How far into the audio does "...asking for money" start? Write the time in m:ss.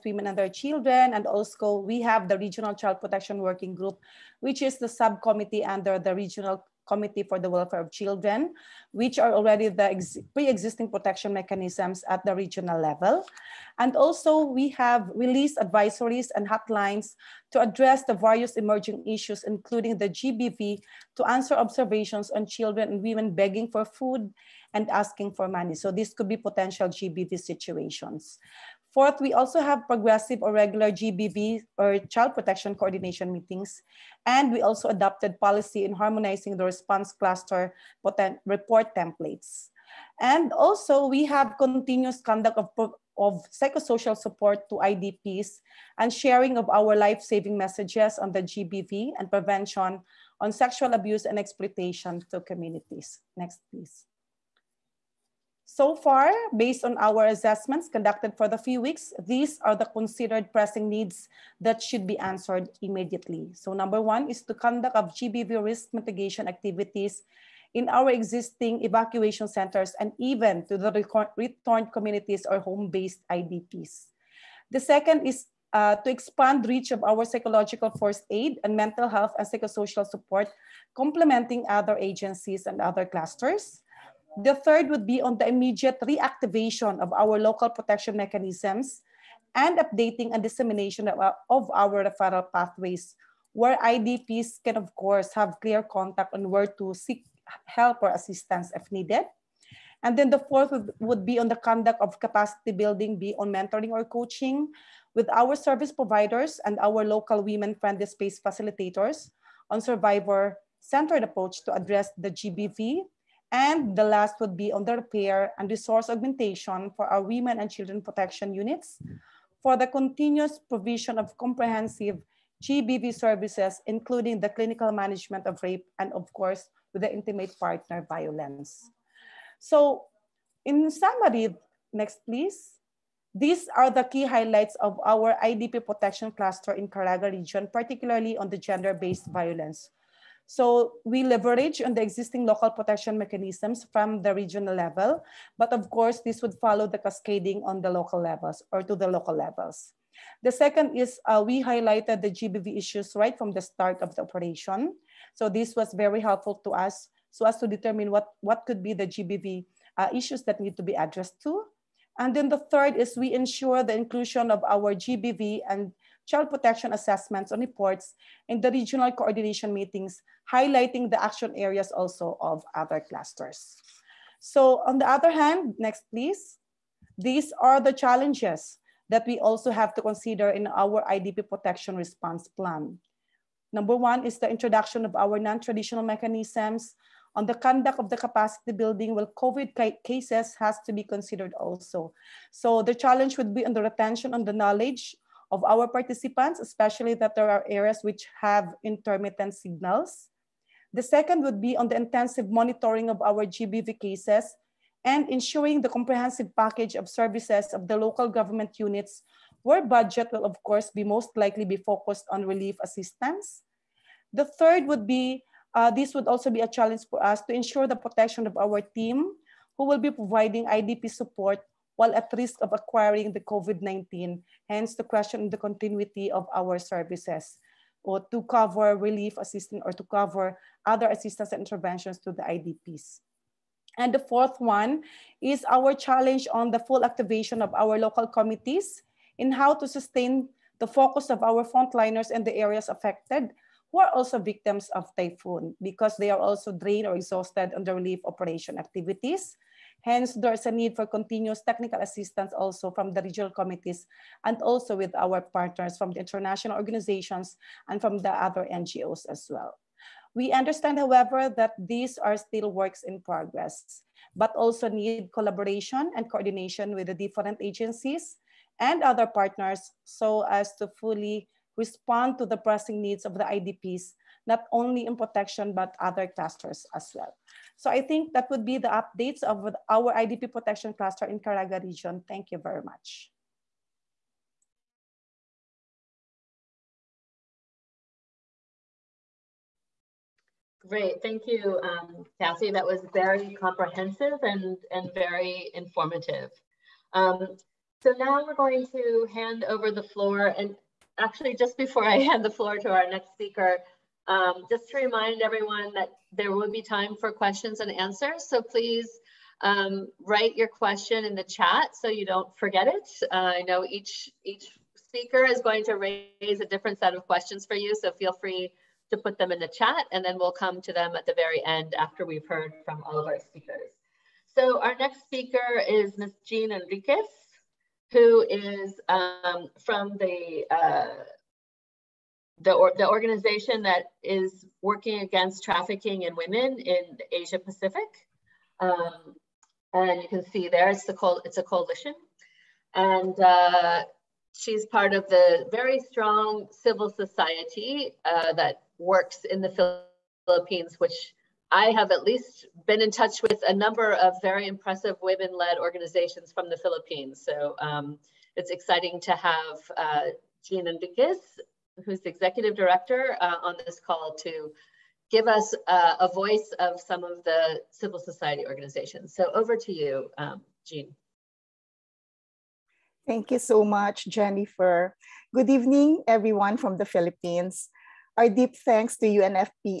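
0:24.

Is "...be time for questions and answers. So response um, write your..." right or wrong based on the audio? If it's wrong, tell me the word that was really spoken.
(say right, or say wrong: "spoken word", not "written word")
wrong: "please", not "response".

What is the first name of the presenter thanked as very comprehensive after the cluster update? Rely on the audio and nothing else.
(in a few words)
Cassie.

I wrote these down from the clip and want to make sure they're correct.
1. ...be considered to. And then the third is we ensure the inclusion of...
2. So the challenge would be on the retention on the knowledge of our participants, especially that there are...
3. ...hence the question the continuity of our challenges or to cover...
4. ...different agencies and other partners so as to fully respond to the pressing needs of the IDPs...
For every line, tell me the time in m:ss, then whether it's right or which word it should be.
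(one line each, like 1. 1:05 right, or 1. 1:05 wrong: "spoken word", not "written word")
1. 2:40 wrong: "addressed", not "considered"
2. 3:12 right
3. 3:44 wrong: "services", not "challenges"
4. 4:27 right.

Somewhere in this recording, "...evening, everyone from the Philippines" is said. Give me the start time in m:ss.
6:15.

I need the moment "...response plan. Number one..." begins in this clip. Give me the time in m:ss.
3:01.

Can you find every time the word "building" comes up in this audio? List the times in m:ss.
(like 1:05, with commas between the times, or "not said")
1:42, 3:08.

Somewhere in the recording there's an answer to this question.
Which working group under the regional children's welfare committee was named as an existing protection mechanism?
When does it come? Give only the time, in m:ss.
0:02.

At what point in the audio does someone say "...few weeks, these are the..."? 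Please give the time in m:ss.
0:58.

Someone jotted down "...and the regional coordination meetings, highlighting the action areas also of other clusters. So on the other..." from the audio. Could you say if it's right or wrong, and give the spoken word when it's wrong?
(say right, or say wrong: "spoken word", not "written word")
right.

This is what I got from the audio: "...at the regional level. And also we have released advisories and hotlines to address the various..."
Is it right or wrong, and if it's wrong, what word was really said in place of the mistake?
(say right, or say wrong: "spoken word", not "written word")
right.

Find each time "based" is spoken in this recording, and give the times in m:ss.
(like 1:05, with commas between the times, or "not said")
0:56, 1:12, 2:18.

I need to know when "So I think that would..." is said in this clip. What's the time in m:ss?
4:37.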